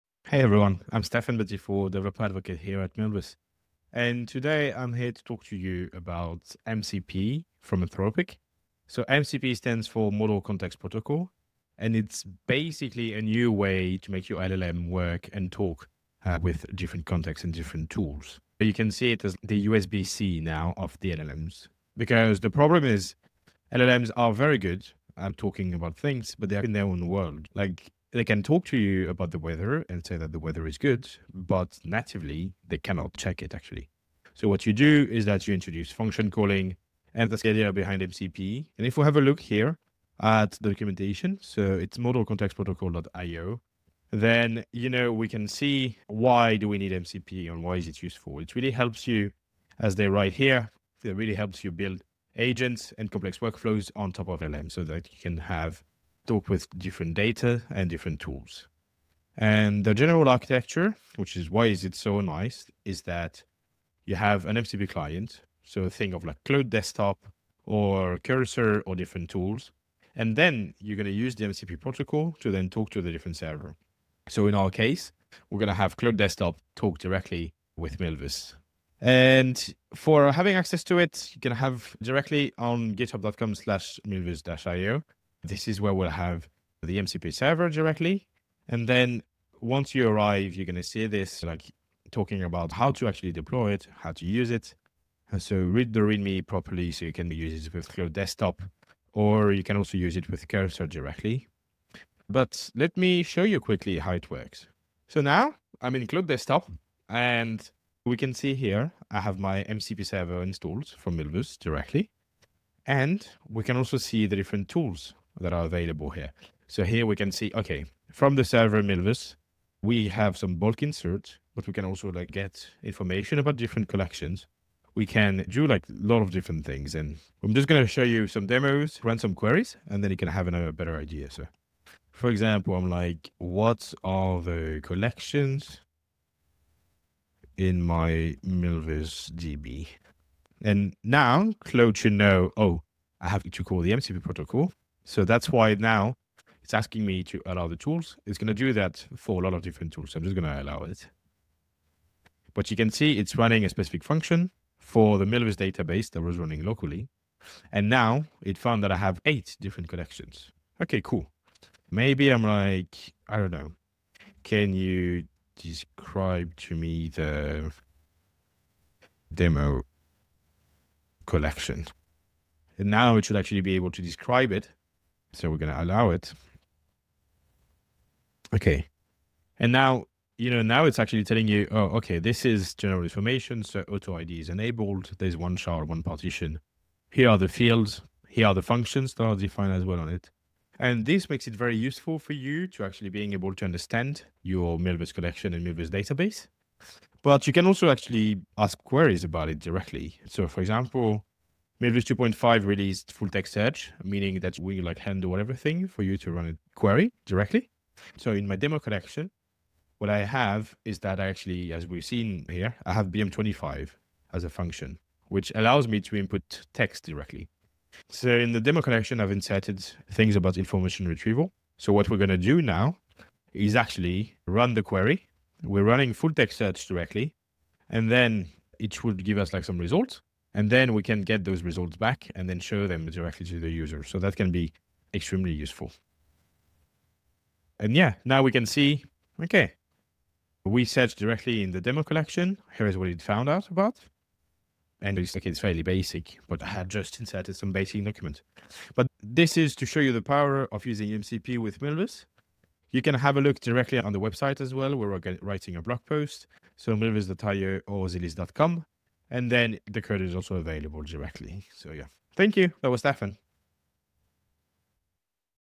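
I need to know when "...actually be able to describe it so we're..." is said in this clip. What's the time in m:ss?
2:53.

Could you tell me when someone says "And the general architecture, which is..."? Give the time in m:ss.
0:59.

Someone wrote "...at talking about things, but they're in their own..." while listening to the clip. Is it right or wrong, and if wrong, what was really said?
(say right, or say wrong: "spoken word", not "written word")
right.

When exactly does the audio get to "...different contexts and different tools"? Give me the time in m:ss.
0:16.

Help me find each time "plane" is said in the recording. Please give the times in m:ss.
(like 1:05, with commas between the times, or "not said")
not said.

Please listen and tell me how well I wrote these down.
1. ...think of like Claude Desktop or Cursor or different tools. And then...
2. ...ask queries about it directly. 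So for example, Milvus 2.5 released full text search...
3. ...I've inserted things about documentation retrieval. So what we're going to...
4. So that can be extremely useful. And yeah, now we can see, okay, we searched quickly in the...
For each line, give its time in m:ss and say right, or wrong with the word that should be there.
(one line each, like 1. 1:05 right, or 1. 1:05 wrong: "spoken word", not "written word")
1. 1:05 right
2. 3:18 right
3. 3:39 wrong: "information", not "documentation"
4. 3:54 wrong: "directly", not "quickly".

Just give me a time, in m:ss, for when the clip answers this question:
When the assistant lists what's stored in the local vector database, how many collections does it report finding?
2:39.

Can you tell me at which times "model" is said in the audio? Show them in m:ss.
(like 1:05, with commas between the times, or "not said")
0:10, 0:41.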